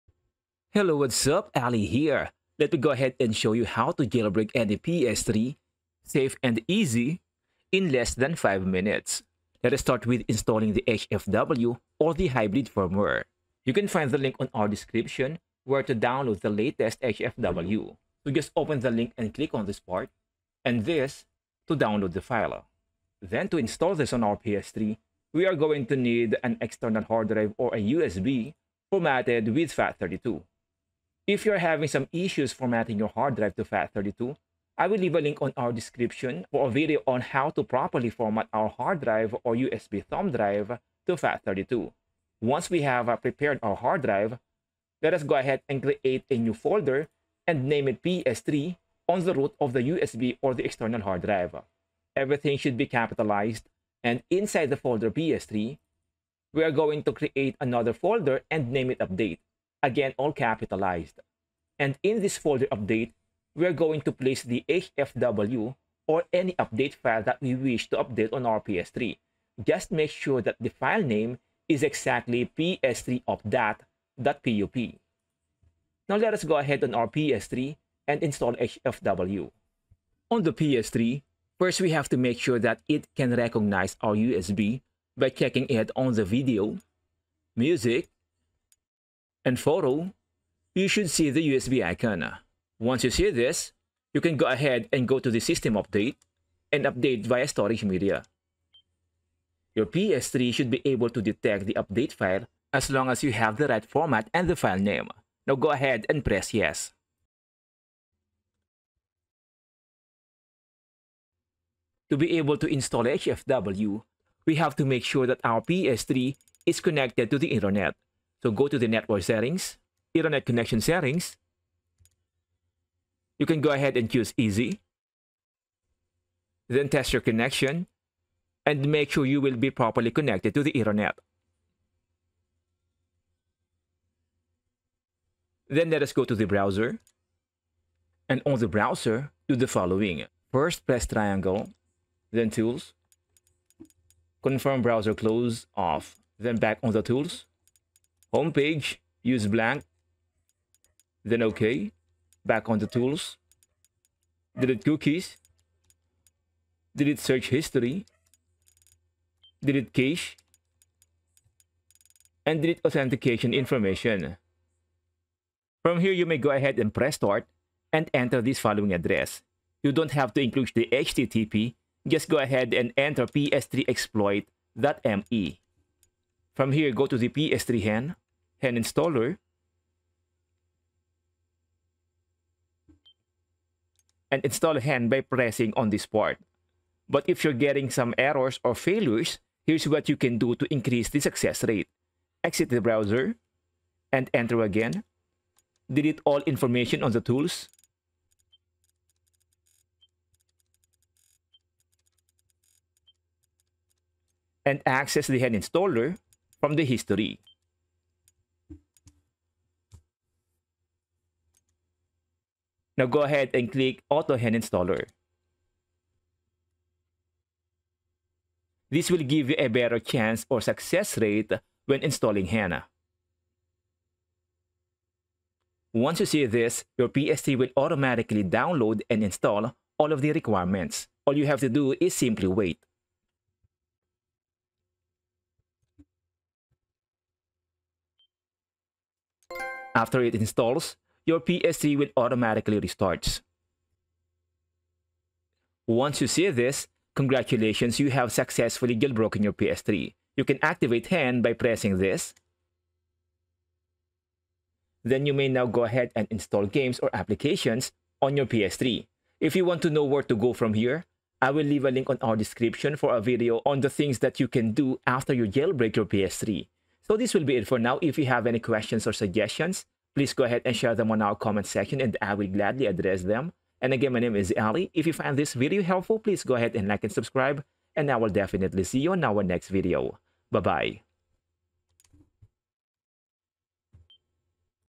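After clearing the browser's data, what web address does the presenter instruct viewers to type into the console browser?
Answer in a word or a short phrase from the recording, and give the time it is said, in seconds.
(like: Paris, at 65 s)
ps3xploit.me, at 173 s.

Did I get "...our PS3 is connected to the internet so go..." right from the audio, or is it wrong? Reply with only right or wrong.
right.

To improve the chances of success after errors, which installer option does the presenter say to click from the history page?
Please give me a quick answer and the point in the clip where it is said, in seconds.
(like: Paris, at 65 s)
AutoHEN Installer, at 214 s.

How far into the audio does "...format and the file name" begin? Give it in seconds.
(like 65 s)
103 s.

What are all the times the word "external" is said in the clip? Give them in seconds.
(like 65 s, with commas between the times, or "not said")
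26 s, 50 s.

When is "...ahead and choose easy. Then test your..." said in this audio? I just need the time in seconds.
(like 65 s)
123 s.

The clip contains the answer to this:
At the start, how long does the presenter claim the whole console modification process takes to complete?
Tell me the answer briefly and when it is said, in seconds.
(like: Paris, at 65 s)
Less than 5 minutes, at 7 s.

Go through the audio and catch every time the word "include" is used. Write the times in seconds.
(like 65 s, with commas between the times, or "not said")
170 s.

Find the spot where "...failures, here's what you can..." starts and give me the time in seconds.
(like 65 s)
188 s.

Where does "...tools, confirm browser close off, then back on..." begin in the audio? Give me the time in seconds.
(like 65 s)
142 s.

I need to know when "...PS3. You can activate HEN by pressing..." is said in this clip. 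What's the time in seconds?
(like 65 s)
249 s.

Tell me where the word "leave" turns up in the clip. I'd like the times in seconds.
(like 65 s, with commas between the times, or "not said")
34 s, 261 s.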